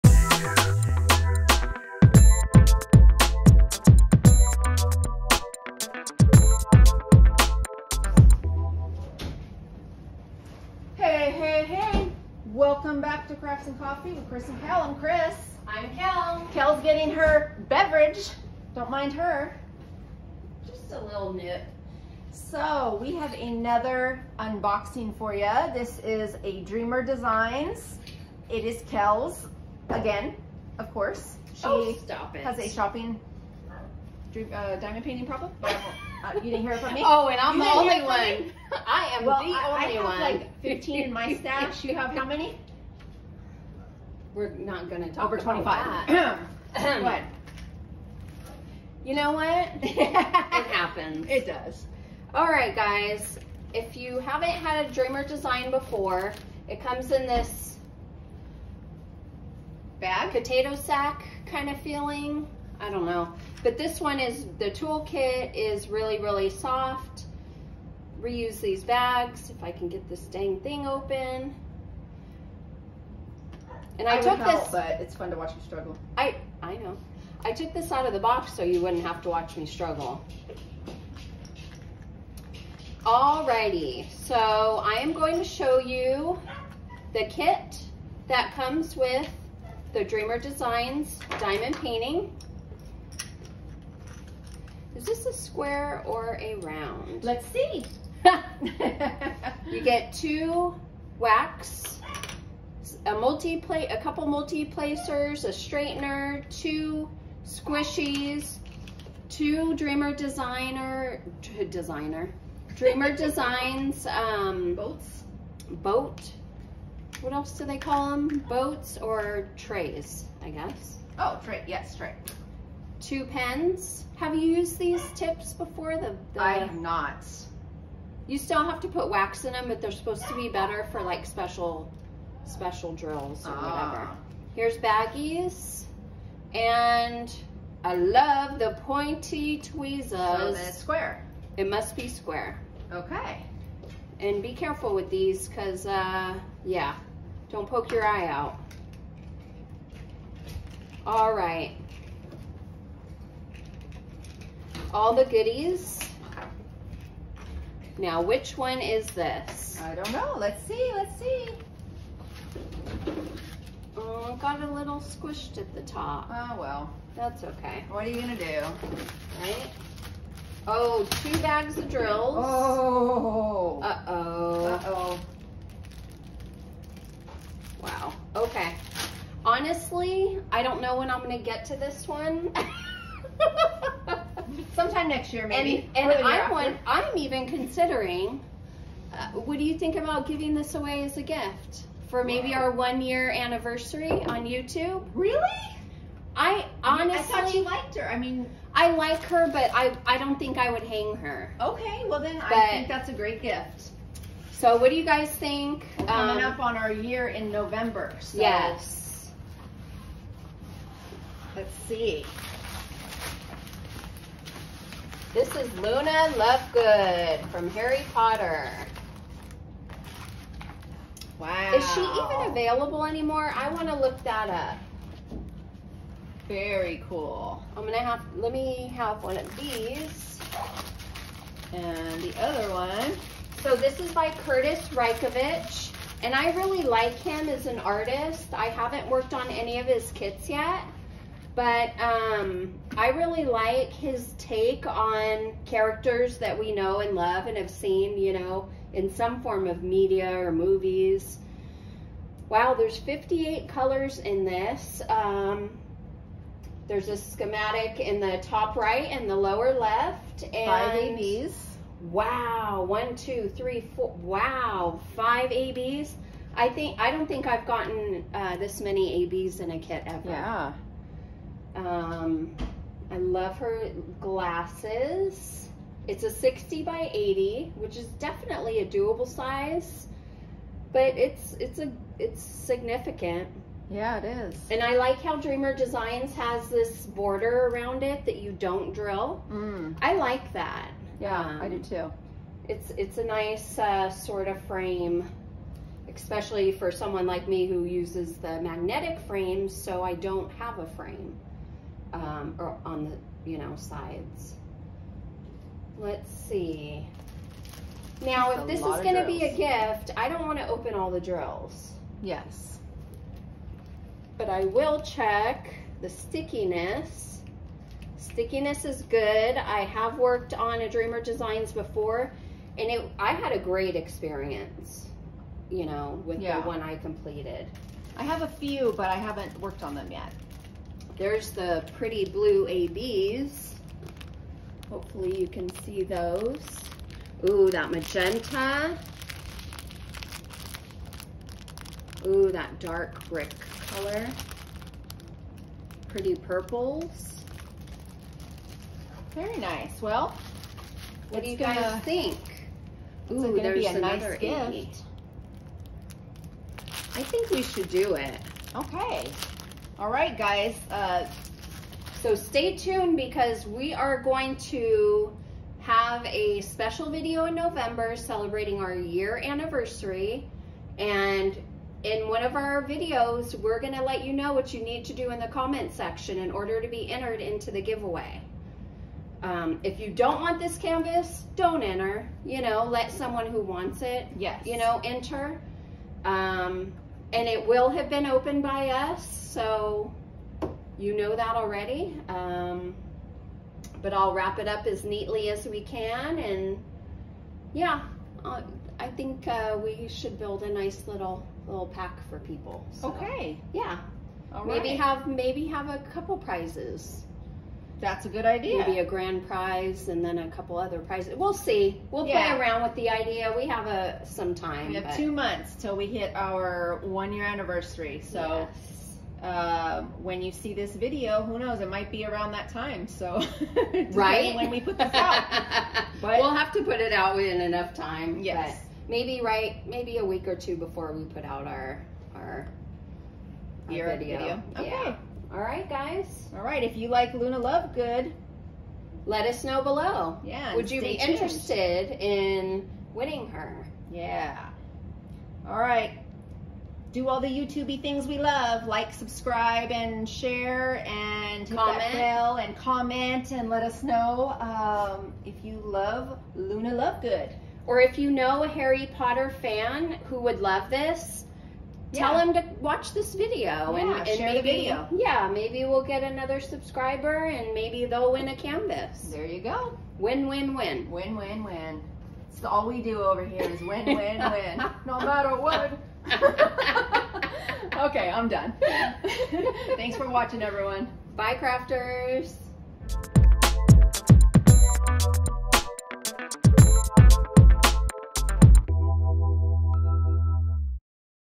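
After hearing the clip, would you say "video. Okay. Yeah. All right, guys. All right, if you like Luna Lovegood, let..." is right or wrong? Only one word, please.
right.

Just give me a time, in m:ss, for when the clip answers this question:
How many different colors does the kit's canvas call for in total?
4:12.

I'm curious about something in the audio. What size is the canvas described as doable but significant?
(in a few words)
60 by 80.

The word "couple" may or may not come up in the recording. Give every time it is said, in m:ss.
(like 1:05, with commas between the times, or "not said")
1:44, 6:46, 6:50.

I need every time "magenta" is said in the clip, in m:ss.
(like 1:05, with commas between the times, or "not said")
5:37.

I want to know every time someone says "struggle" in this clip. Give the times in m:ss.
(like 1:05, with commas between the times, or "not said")
1:15, 1:19.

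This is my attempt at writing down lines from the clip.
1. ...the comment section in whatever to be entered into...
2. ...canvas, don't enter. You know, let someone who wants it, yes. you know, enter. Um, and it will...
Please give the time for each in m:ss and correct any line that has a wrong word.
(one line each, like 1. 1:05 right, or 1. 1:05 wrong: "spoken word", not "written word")
1. 6:15 wrong: "order", not "whatever"
2. 6:20 right.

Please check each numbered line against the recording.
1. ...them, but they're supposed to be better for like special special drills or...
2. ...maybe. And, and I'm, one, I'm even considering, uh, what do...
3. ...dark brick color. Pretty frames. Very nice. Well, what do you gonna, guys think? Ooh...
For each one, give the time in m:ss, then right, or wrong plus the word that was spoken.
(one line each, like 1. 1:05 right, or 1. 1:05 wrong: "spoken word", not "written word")
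1. 2:09 right
2. 3:05 right
3. 5:42 wrong: "purples", not "frames".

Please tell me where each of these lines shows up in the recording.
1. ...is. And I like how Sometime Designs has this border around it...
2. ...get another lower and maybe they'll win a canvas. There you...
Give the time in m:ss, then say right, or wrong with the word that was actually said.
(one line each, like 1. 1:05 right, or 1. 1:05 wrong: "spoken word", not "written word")
1. 4:44 wrong: "Dreamer", not "Sometime"
2. 7:46 wrong: "subscriber", not "lower".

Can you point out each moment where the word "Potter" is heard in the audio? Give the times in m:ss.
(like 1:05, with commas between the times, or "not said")
3:38, 7:39.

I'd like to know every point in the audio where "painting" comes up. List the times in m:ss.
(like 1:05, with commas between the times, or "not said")
0:35, 1:31.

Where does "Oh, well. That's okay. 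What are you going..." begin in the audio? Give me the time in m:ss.
2:46.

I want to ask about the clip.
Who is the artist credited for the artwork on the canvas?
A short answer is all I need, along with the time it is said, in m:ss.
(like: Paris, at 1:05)
Kurtis Rykovich, at 3:54.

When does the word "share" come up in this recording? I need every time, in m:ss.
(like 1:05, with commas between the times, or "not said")
7:30, 7:44.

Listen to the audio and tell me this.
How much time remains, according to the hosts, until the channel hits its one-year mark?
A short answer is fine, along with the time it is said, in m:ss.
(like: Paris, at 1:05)
2 months, at 6:55.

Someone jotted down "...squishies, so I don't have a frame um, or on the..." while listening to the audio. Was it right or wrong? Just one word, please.
wrong.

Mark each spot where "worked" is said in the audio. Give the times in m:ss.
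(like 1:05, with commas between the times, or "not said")
3:59, 5:20, 5:29.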